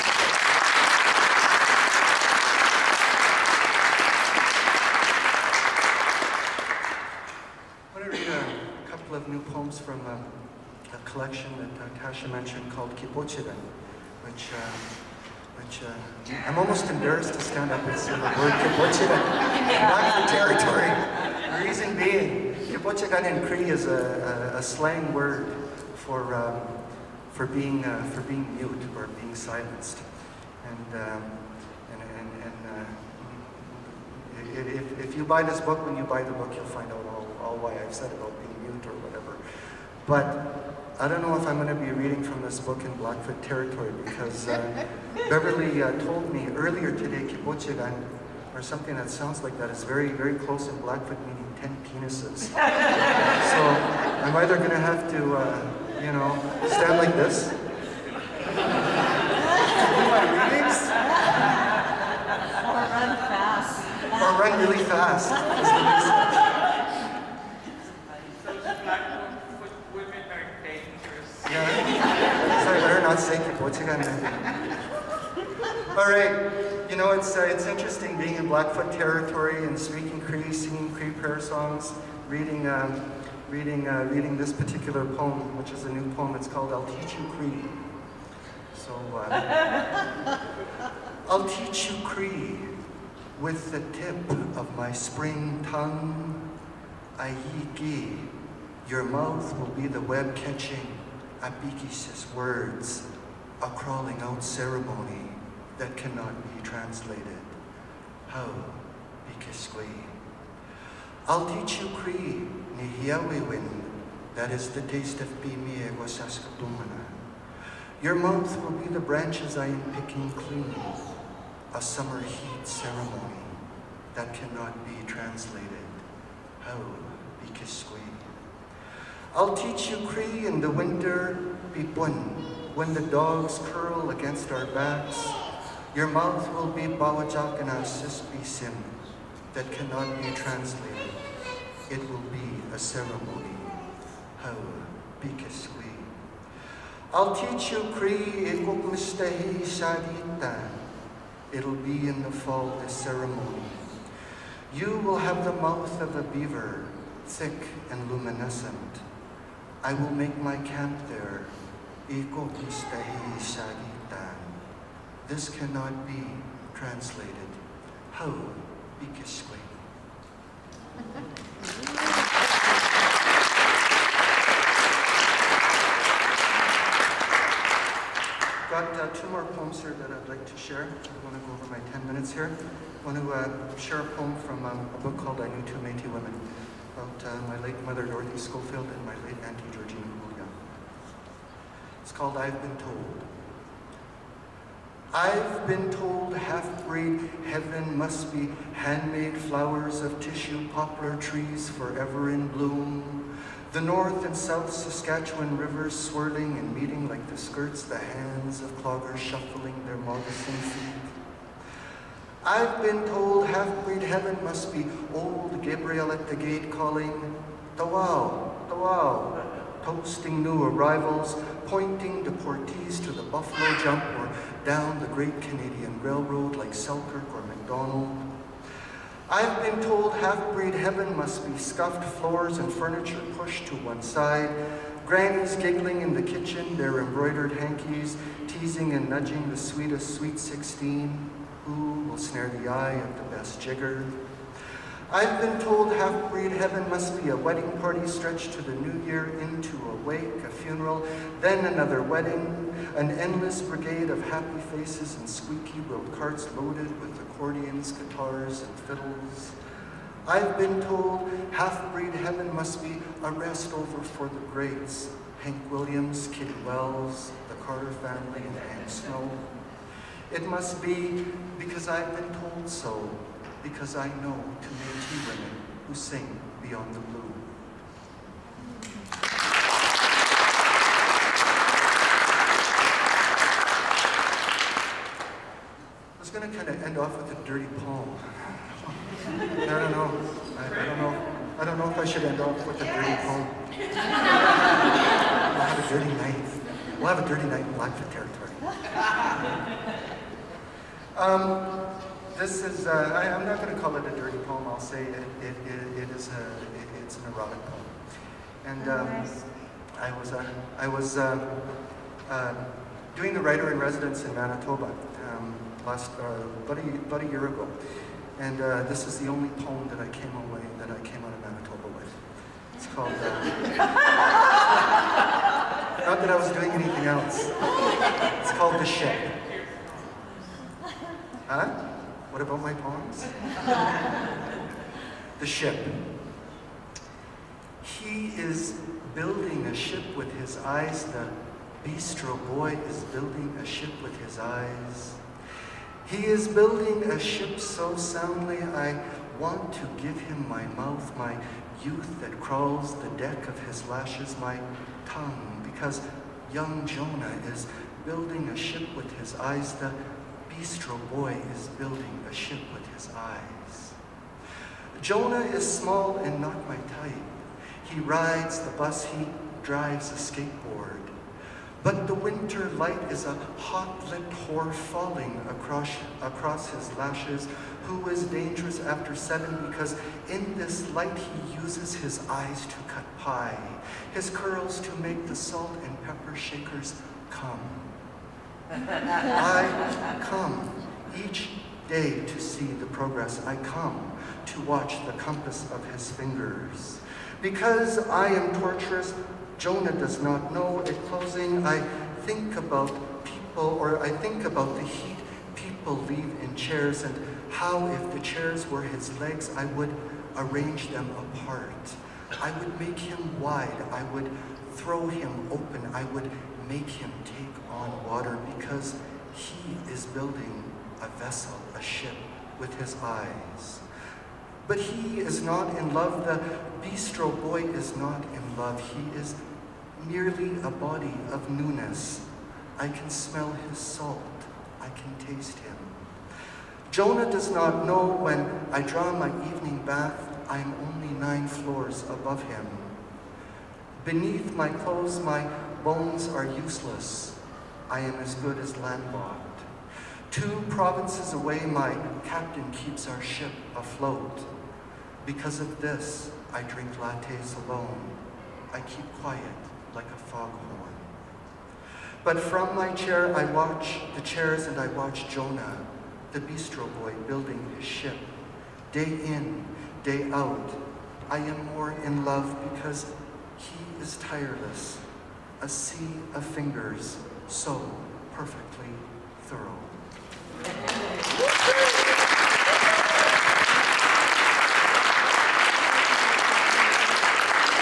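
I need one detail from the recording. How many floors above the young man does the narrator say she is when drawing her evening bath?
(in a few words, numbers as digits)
9.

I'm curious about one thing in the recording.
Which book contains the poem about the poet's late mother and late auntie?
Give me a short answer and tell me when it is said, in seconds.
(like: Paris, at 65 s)
I Knew Two Métis Women, at 185 s.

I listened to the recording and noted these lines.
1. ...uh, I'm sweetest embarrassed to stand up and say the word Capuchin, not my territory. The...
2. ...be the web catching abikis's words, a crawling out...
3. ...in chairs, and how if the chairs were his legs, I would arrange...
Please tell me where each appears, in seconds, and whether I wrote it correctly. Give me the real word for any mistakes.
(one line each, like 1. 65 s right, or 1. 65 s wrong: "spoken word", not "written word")
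1. 15 s wrong: "almost", not "sweetest"
2. 99 s right
3. 406 s right.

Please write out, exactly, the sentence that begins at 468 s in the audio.
Day in, day out, I am more in love because he is tireless, a sea of fingers so perfectly thorough.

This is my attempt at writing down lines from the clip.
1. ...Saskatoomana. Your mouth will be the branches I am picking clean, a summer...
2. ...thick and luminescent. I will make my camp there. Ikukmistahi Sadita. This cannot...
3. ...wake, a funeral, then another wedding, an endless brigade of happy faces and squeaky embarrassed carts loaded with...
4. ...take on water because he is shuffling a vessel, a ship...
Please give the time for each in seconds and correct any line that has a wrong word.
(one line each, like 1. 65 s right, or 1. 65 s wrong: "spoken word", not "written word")
1. 116 s right
2. 157 s right
3. 250 s wrong: "wheeled", not "embarrassed"
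4. 417 s wrong: "building", not "shuffling".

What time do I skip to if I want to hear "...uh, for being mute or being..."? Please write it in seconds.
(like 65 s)
27 s.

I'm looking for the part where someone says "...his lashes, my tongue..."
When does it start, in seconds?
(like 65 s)
353 s.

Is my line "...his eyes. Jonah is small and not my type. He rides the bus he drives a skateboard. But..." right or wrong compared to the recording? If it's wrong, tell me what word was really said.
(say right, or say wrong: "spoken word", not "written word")
right.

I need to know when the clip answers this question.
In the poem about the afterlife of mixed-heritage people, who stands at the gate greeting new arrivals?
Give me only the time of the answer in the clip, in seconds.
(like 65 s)
215 s.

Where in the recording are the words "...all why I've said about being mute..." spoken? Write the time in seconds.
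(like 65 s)
37 s.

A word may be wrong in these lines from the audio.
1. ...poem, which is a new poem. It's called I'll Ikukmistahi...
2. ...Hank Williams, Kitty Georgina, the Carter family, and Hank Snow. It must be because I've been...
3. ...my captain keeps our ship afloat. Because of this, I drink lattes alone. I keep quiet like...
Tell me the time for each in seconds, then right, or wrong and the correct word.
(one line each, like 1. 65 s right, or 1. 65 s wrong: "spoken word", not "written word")
1. 85 s wrong: "Teach", not "Ikukmistahi"
2. 265 s wrong: "Wells", not "Georgina"
3. 451 s right.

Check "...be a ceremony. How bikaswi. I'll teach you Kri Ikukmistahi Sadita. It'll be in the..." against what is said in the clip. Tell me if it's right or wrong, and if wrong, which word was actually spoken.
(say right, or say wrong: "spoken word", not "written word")
right.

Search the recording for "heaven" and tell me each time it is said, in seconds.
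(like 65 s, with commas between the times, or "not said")
197 s, 214 s, 230 s, 246 s, 262 s.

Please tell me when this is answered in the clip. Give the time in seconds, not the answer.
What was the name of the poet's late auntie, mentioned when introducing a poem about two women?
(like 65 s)
189 s.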